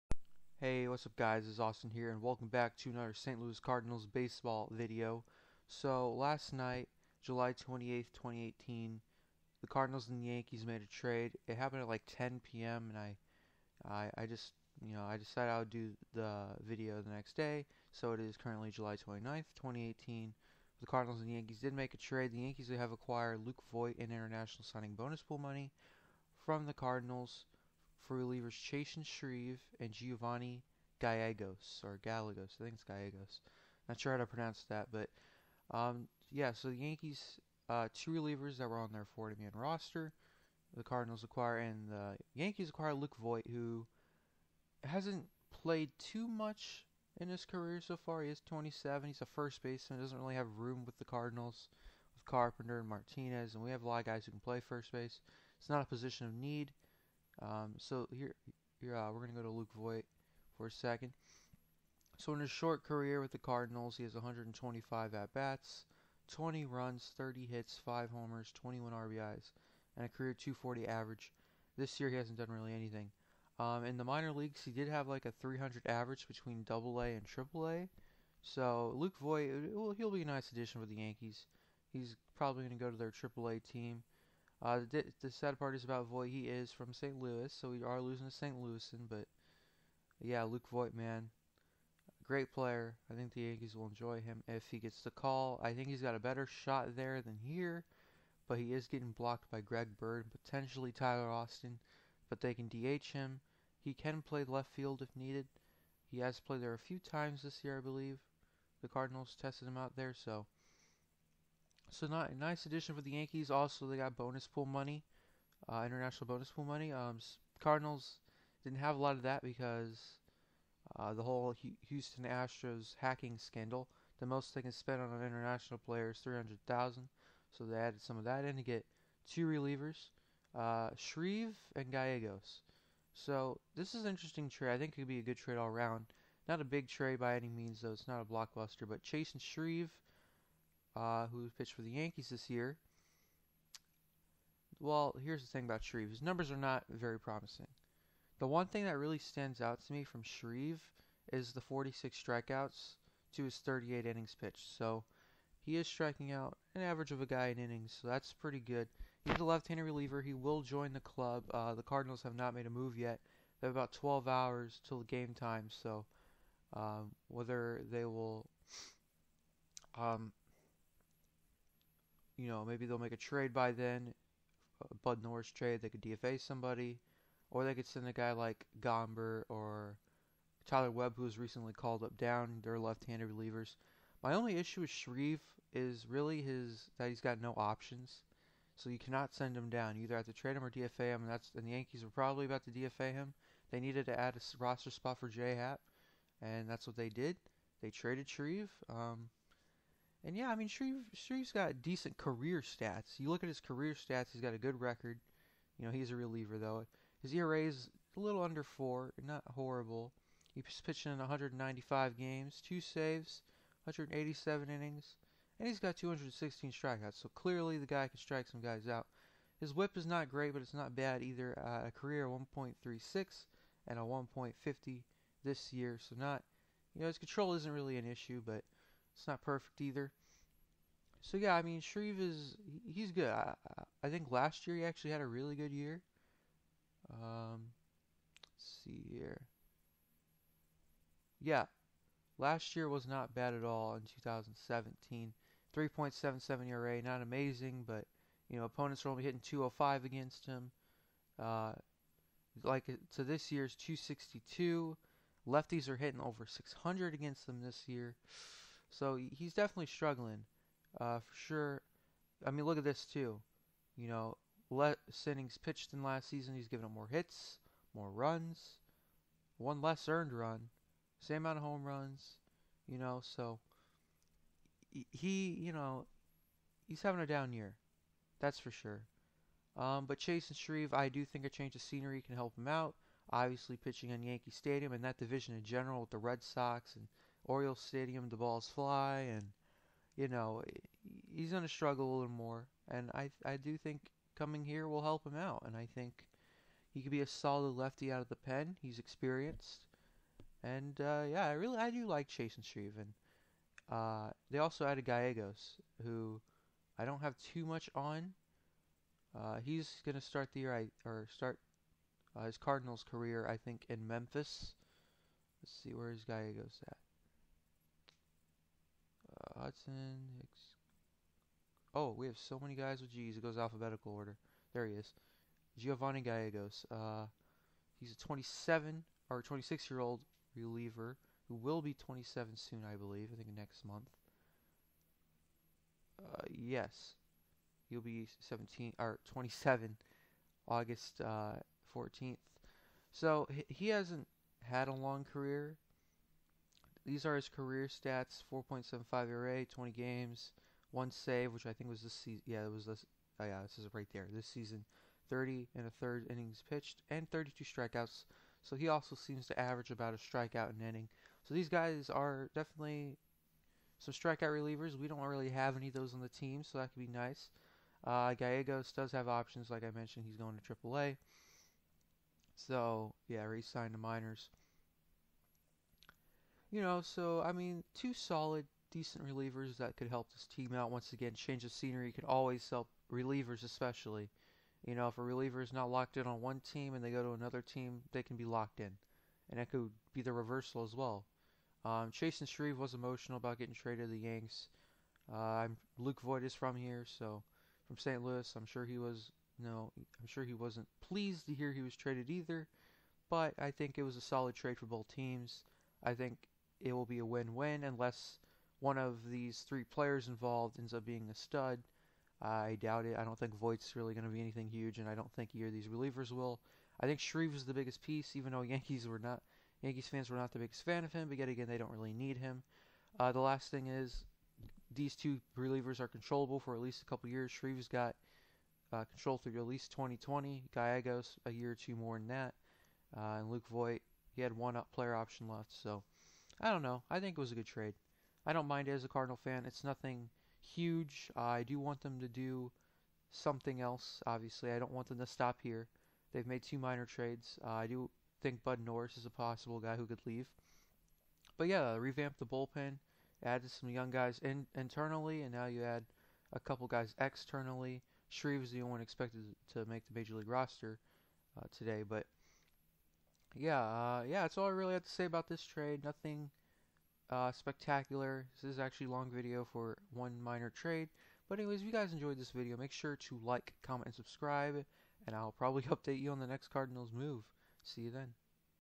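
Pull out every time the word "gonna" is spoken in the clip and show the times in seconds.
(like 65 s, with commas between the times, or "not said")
59 s, 291 s, 310 s.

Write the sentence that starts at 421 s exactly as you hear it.
But yet again, they don't really need him.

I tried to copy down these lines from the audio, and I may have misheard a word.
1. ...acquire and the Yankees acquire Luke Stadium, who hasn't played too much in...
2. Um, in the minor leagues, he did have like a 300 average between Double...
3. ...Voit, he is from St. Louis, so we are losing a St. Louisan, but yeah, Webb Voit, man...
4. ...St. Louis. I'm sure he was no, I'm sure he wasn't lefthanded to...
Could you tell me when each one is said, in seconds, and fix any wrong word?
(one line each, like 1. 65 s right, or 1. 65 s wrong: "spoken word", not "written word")
1. 41 s wrong: "Voit", not "Stadium"
2. 73 s right
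3. 86 s wrong: "Luke", not "Webb"
4. 397 s wrong: "pleased", not "lefthanded".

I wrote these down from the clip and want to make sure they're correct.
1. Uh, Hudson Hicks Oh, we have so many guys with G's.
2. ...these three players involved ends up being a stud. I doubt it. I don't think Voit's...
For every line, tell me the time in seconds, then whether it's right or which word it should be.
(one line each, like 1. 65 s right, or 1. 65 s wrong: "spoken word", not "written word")
1. 319 s right
2. 409 s right.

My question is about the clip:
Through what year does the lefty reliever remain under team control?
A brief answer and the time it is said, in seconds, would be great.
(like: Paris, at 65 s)
2020, at 429 s.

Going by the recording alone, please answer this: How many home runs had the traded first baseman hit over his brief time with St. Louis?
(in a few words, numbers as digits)
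5.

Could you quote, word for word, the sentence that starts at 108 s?
The Cardinals tested him out there, so so not a nice addition for the Yankees.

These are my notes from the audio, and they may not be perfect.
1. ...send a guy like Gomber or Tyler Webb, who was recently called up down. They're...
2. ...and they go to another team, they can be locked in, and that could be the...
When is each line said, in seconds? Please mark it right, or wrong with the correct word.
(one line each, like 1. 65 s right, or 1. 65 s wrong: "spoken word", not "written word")
1. 177 s right
2. 386 s right.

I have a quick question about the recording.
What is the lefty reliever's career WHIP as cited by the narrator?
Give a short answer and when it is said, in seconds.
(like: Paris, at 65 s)
1.36, at 221 s.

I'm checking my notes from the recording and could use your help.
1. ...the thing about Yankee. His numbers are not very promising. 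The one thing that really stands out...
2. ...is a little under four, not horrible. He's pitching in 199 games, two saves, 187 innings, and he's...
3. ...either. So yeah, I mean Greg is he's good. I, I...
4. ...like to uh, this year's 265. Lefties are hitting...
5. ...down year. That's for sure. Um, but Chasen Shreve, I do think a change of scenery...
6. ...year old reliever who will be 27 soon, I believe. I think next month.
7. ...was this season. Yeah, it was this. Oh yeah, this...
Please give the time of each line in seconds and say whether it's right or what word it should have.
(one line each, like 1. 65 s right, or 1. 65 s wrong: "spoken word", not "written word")
1. 145 s wrong: "Shreve", not "Yankee"
2. 207 s wrong: "195", not "199"
3. 229 s wrong: "Shreve", not "Greg"
4. 252 s wrong: "262", not "265"
5. 277 s right
6. 329 s right
7. 351 s right.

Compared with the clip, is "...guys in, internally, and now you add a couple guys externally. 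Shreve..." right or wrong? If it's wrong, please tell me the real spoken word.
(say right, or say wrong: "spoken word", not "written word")
right.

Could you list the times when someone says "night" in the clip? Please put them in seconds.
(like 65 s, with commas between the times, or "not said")
6 s.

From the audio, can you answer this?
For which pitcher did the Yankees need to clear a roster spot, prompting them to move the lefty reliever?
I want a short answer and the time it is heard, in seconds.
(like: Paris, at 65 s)
J.A. Happ, at 195 s.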